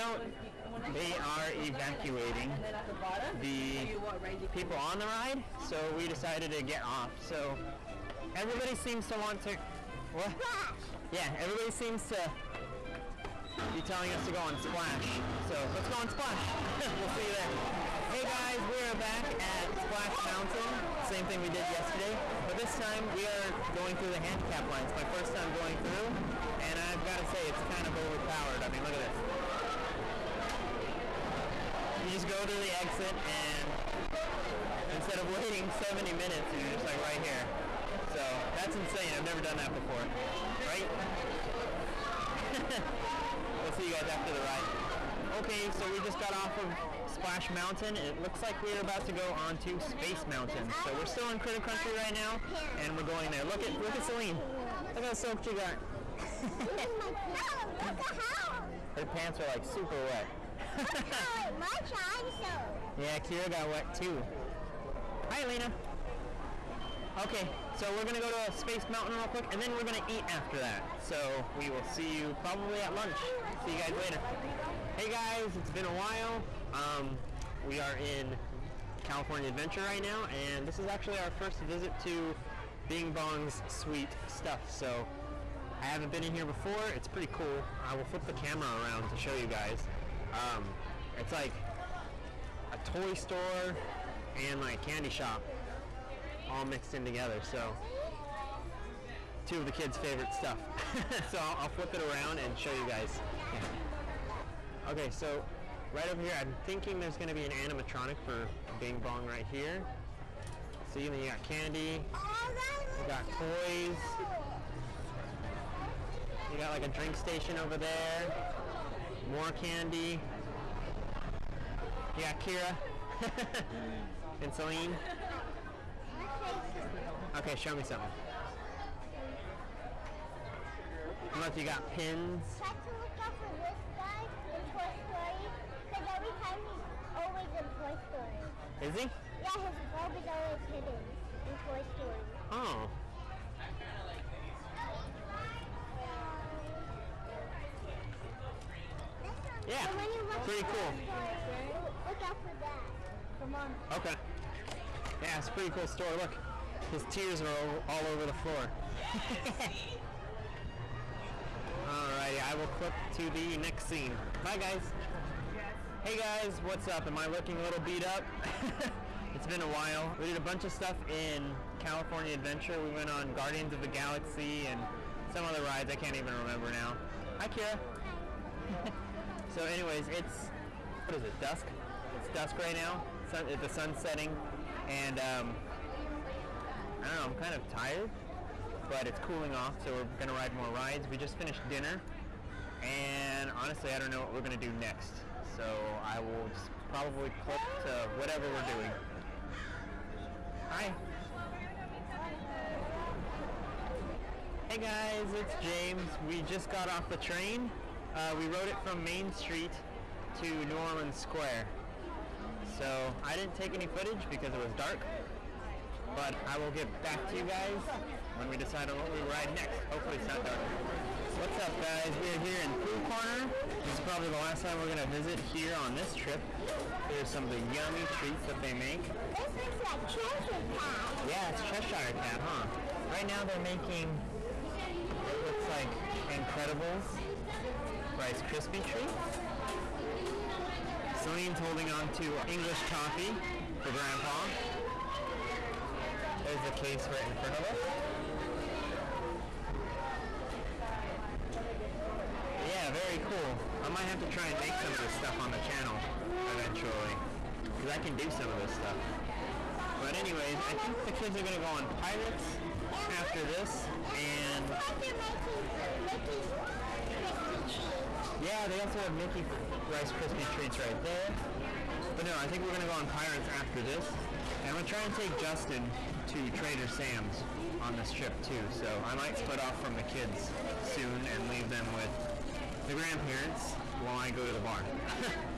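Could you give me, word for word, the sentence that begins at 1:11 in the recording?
So we will see you probably at lunch.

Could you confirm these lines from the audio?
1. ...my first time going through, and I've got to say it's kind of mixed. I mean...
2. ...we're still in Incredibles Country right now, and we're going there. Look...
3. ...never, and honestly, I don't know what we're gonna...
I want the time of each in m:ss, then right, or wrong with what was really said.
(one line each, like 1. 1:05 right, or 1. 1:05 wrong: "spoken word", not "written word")
1. 0:24 wrong: "overpowered", not "mixed"
2. 0:50 wrong: "Critter", not "Incredibles"
3. 3:11 wrong: "dinner", not "never".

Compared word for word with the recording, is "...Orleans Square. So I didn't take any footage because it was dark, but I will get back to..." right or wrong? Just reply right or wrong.
right.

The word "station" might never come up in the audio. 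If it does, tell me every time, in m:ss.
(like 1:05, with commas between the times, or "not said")
1:57.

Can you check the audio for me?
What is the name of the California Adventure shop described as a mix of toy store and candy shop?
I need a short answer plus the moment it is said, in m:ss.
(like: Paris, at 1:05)
Bing Bong's Sweet Stuff, at 1:22.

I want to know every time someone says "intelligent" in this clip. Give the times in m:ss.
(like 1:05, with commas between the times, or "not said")
not said.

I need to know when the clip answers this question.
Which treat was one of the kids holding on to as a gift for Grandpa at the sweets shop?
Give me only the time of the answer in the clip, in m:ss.
4:02.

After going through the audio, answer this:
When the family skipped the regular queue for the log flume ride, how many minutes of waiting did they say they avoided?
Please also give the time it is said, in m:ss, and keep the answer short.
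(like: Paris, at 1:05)
70, at 0:35.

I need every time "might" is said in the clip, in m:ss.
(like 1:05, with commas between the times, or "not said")
4:13, 4:39.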